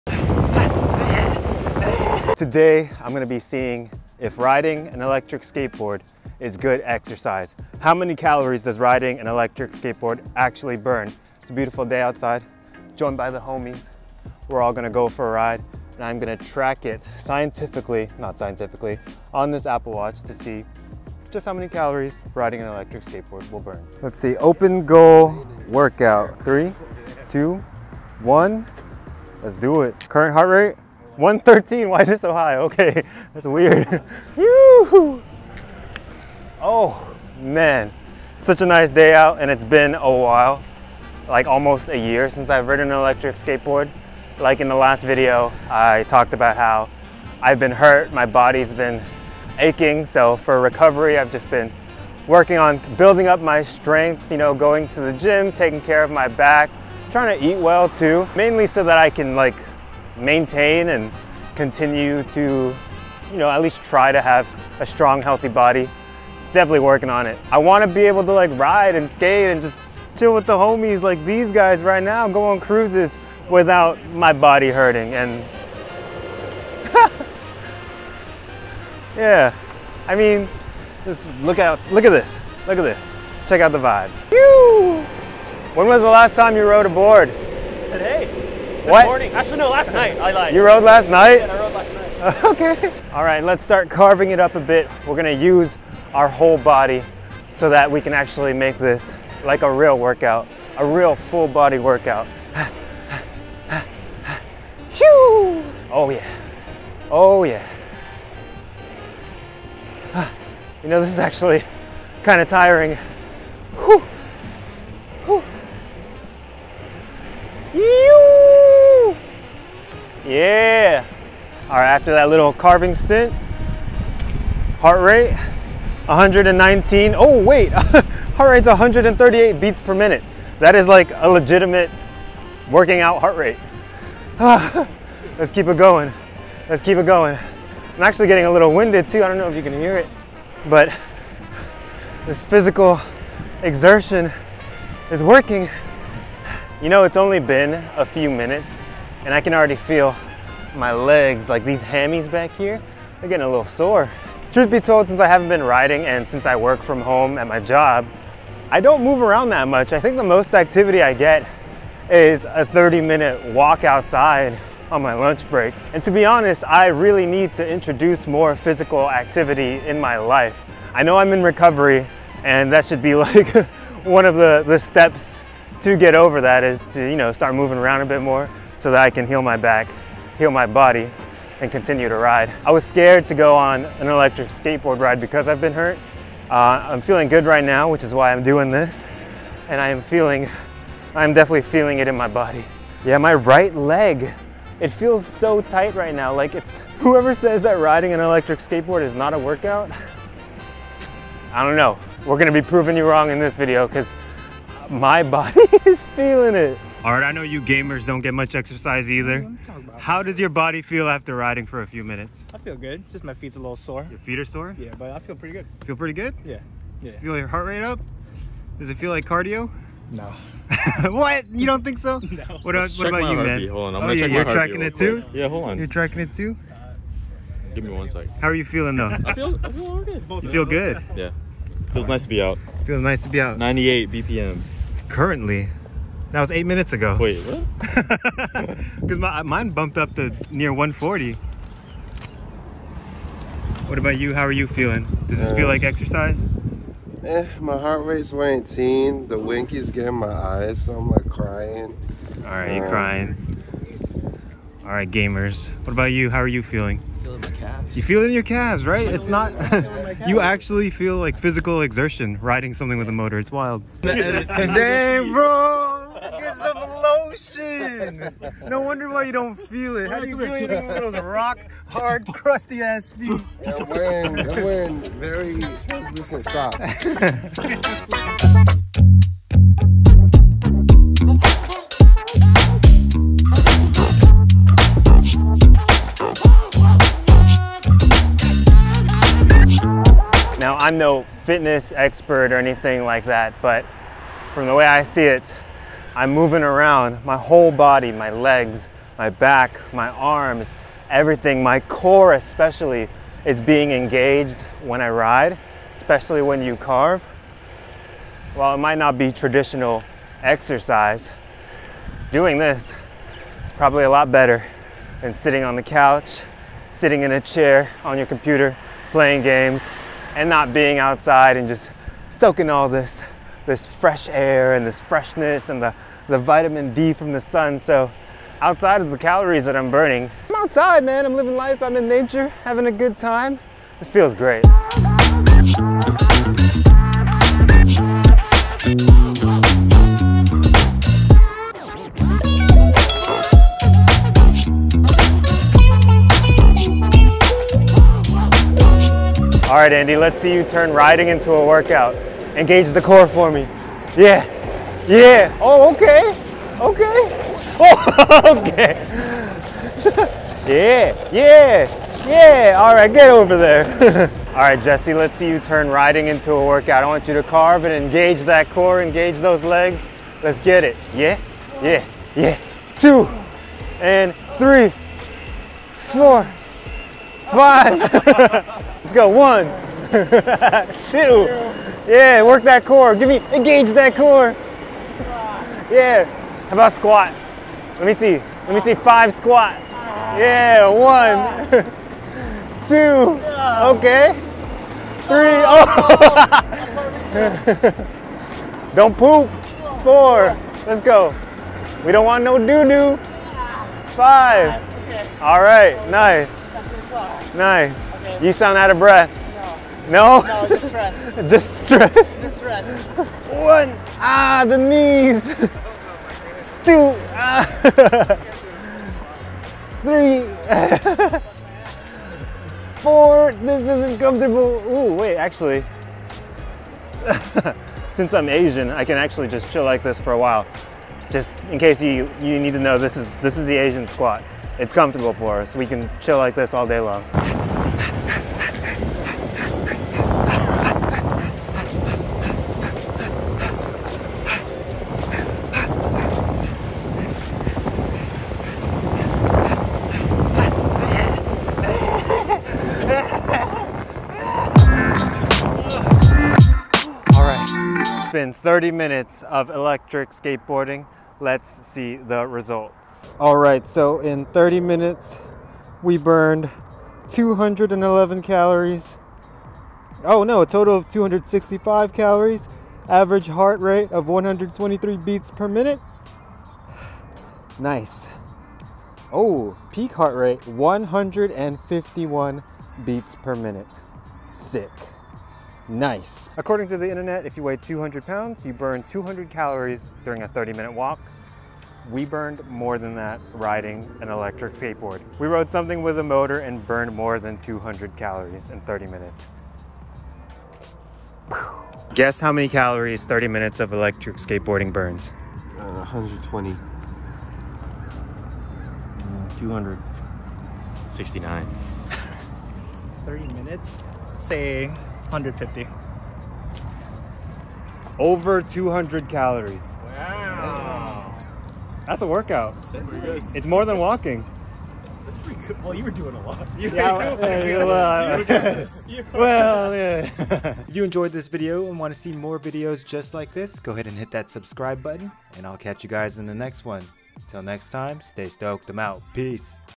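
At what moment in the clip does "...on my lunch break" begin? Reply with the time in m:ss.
2:44.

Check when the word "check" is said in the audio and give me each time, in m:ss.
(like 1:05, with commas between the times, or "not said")
1:23, 3:44.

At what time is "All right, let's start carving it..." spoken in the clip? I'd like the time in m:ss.
1:33.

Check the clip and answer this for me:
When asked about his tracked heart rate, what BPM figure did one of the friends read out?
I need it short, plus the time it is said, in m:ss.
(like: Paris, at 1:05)
98, at 3:53.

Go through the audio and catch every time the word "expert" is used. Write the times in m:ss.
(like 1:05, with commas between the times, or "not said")
4:51.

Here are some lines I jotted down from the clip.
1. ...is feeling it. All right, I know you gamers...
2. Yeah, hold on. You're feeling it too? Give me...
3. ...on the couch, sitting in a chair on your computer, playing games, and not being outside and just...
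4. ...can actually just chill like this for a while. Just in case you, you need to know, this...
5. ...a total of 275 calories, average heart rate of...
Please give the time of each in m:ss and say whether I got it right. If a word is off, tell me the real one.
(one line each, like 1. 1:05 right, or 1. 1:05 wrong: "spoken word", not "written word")
1. 3:25 right
2. 3:45 wrong: "tracking", not "feeling"
3. 5:15 right
4. 7:09 right
5. 7:50 wrong: "265", not "275".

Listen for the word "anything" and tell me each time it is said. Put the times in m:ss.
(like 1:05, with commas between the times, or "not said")
4:30, 4:52.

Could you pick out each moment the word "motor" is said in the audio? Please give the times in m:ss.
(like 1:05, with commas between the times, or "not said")
4:23, 8:16.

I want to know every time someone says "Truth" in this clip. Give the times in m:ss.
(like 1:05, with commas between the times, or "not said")
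2:34.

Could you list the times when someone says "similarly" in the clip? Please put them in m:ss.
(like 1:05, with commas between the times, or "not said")
not said.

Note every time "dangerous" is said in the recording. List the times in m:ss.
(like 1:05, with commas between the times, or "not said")
not said.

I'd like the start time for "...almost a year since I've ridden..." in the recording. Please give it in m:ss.
0:41.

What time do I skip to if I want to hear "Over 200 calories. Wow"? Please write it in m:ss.
8:38.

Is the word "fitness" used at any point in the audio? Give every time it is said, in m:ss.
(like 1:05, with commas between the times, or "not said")
4:51.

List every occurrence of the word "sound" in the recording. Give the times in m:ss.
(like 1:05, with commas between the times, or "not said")
6:48.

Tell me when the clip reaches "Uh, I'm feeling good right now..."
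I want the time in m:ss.
3:06.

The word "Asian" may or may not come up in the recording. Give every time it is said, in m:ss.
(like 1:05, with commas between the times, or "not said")
7:08, 7:13.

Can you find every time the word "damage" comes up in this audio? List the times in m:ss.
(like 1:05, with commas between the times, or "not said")
not said.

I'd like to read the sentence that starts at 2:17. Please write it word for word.
I'm actually getting a little winded too.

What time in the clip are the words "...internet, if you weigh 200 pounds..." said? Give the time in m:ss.
8:07.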